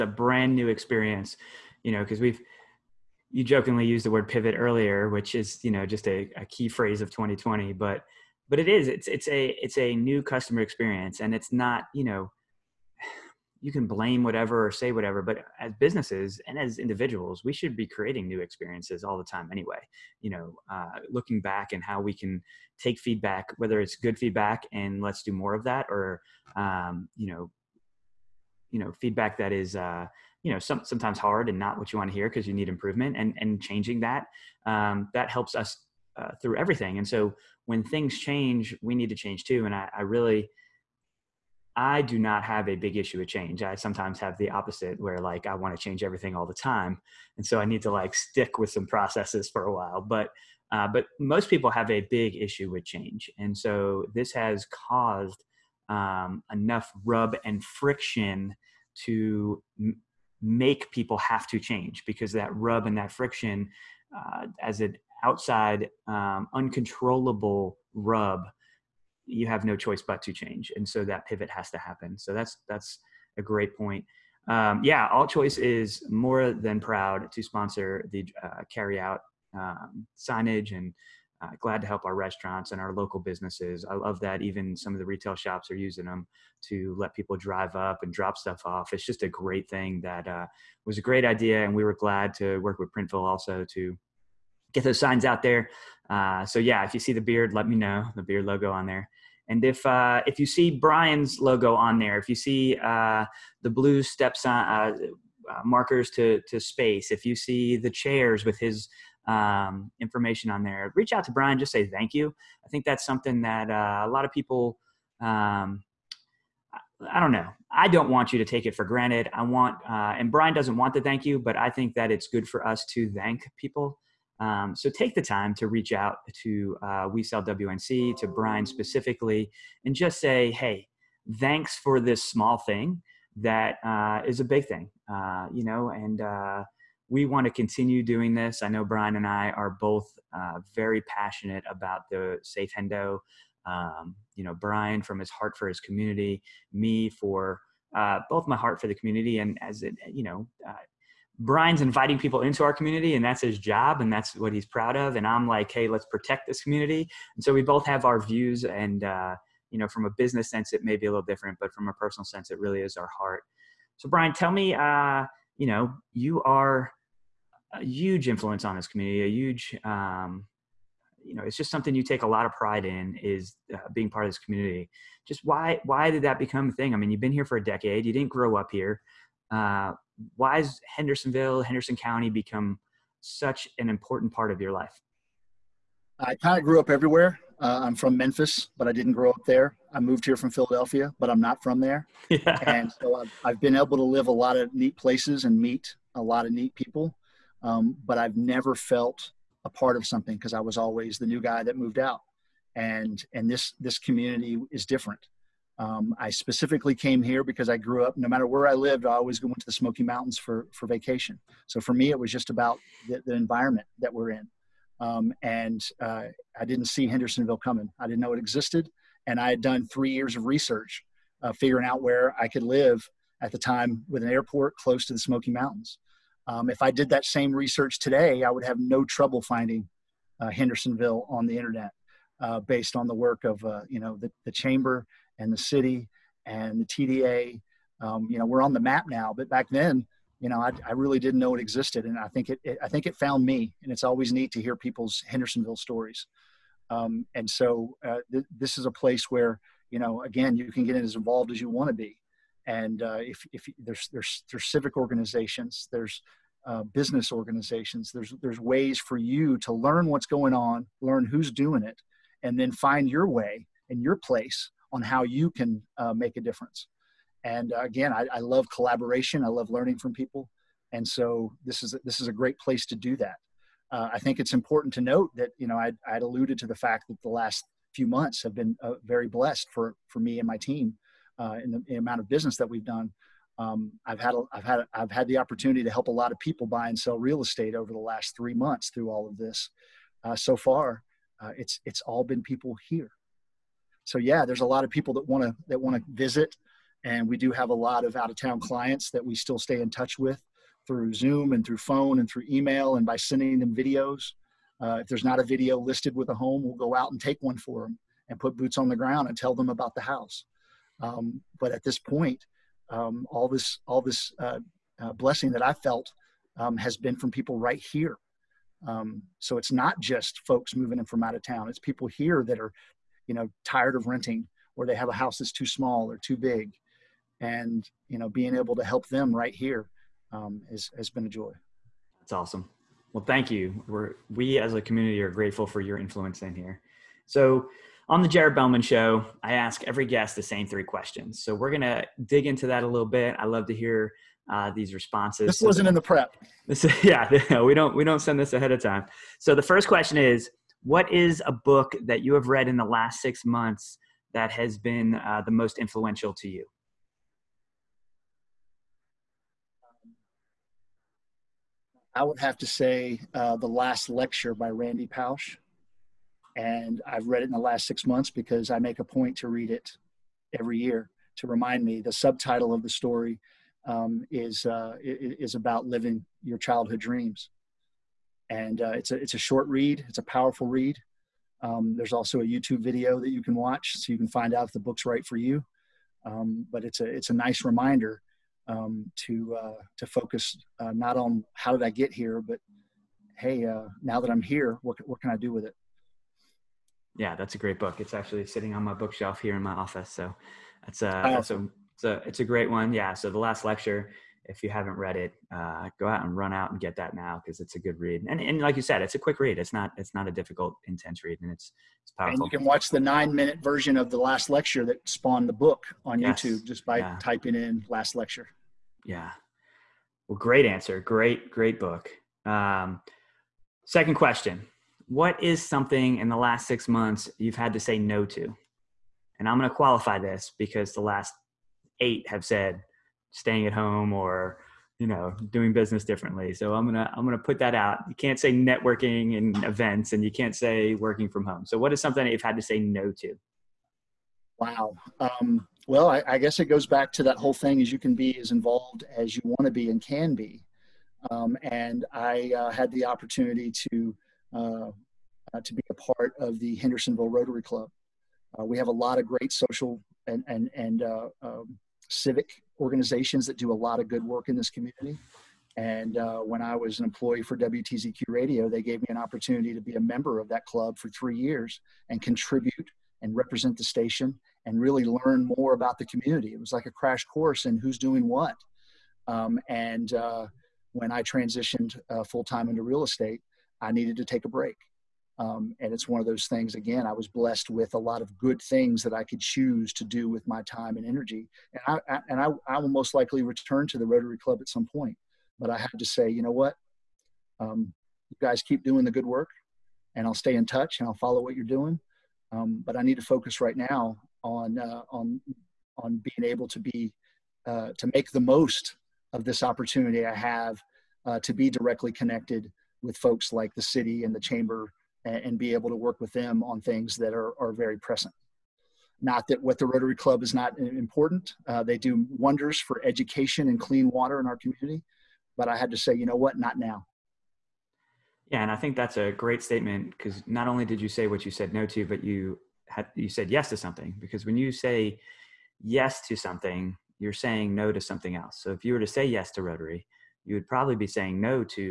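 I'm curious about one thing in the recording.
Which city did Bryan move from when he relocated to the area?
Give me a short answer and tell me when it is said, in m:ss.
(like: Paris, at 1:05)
Philadelphia, at 3:10.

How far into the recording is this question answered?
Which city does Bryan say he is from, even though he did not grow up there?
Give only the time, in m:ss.
3:08.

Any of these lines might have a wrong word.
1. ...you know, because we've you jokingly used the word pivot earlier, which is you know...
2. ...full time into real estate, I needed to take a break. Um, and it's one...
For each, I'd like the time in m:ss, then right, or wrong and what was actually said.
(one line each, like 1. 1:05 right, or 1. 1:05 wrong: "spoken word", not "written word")
1. 0:01 right
2. 8:02 right.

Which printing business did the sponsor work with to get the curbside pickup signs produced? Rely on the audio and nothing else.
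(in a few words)
Printville.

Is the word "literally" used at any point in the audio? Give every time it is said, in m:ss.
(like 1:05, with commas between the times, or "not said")
not said.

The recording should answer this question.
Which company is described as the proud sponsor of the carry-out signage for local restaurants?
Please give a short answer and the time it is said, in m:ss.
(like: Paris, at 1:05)
ALLCHOICE, at 1:15.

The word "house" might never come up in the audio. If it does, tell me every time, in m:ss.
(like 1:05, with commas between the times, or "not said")
5:10, 5:25.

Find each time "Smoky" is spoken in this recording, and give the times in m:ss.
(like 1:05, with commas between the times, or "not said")
3:29, 3:45.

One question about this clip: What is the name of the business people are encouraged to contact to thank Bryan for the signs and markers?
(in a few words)
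We Sell WNC.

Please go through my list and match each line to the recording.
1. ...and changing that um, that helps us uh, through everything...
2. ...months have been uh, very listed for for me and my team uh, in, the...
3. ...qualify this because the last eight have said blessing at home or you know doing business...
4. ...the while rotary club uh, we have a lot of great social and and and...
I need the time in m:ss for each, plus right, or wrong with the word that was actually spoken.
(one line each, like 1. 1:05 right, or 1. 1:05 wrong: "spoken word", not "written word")
1. 0:33 right
2. 4:38 wrong: "blessed", not "listed"
3. 7:09 wrong: "staying", not "blessing"
4. 7:36 wrong: "hendersonville", not "while".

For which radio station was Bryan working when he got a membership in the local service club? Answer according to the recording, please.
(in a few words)
WTZQ Radio.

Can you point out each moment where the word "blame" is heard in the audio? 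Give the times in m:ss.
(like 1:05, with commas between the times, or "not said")
0:13.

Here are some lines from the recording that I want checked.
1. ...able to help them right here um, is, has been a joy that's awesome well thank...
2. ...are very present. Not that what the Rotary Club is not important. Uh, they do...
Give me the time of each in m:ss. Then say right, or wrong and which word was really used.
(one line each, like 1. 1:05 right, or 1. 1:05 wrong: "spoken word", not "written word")
1. 5:28 right
2. 8:37 right.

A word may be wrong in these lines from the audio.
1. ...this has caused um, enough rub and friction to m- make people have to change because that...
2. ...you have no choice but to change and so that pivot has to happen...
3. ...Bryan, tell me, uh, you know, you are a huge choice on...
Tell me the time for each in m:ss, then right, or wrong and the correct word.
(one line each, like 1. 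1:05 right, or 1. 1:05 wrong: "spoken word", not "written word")
1. 0:54 right
2. 1:09 right
3. 2:44 wrong: "influence", not "choice".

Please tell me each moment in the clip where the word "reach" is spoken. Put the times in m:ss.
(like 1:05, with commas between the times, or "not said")
1:50, 2:05.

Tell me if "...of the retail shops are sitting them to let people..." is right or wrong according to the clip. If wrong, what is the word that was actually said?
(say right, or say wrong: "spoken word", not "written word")
wrong: "using", not "sitting".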